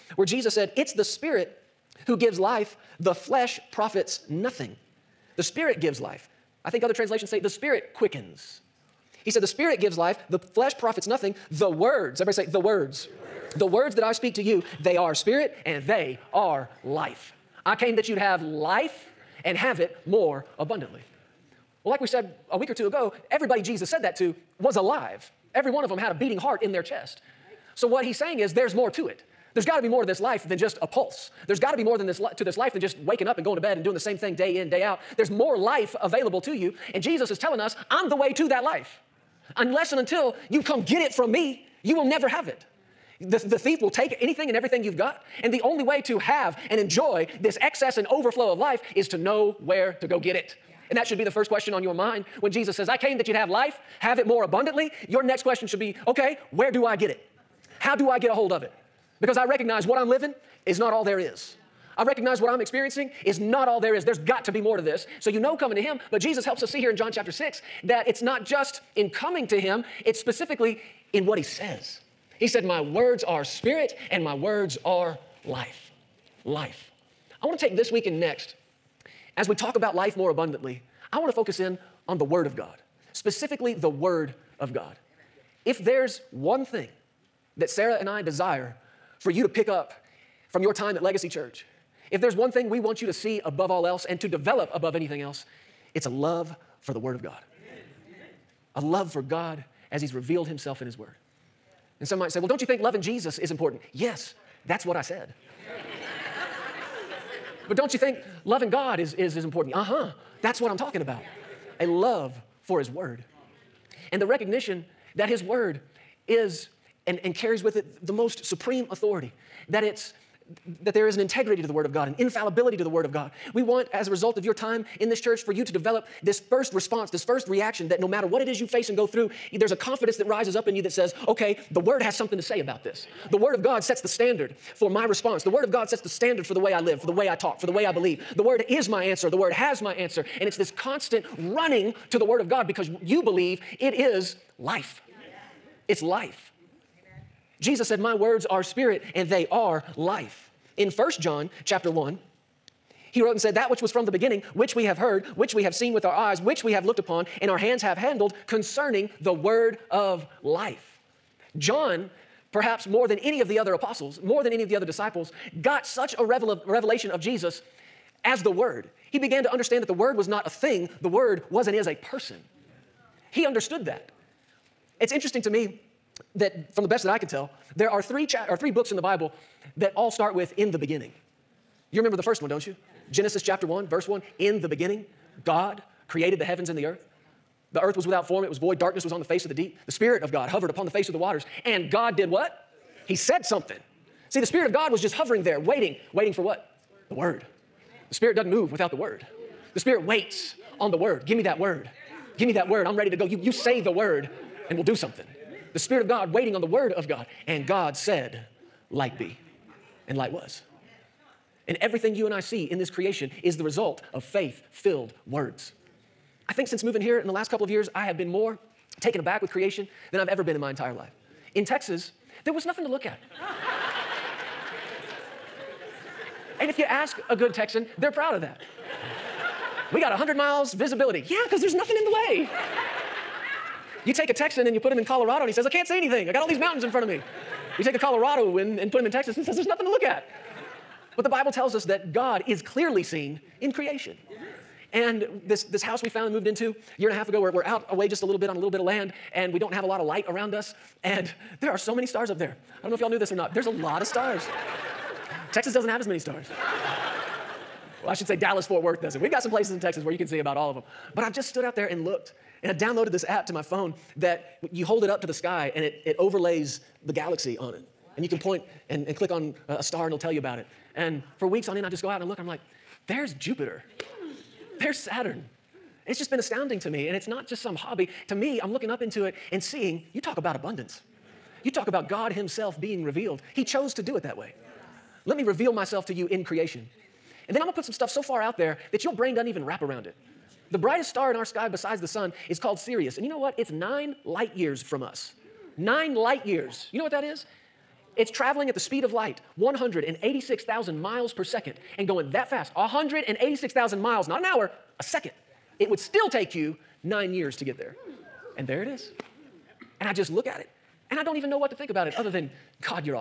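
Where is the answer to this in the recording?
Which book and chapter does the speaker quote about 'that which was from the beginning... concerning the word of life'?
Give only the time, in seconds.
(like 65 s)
150 s.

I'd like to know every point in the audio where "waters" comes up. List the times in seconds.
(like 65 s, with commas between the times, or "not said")
191 s.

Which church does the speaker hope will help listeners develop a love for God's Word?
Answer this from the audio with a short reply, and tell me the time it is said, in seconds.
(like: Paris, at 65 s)
Legacy Church, at 91 s.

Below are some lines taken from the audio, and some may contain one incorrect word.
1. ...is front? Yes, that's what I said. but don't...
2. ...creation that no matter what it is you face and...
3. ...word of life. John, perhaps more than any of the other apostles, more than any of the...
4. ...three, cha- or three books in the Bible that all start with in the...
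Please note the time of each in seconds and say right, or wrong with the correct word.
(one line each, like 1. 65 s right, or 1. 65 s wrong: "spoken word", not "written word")
1. 103 s wrong: "important", not "front"
2. 127 s wrong: "reaction", not "creation"
3. 159 s right
4. 178 s right.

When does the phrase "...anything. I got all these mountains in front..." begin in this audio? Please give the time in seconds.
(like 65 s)
235 s.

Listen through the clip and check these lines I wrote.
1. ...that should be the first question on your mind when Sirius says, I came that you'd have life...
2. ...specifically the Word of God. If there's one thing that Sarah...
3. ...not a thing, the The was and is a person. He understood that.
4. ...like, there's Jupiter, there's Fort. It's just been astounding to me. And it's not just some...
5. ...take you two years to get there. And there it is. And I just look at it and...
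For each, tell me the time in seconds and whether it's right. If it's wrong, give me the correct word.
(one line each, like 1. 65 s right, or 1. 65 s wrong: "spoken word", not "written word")
1. 50 s wrong: "Jesus", not "Sirius"
2. 83 s right
3. 170 s wrong: "Word", not "The"
4. 272 s wrong: "Saturn", not "Fort"
5. 306 s wrong: "nine", not "two".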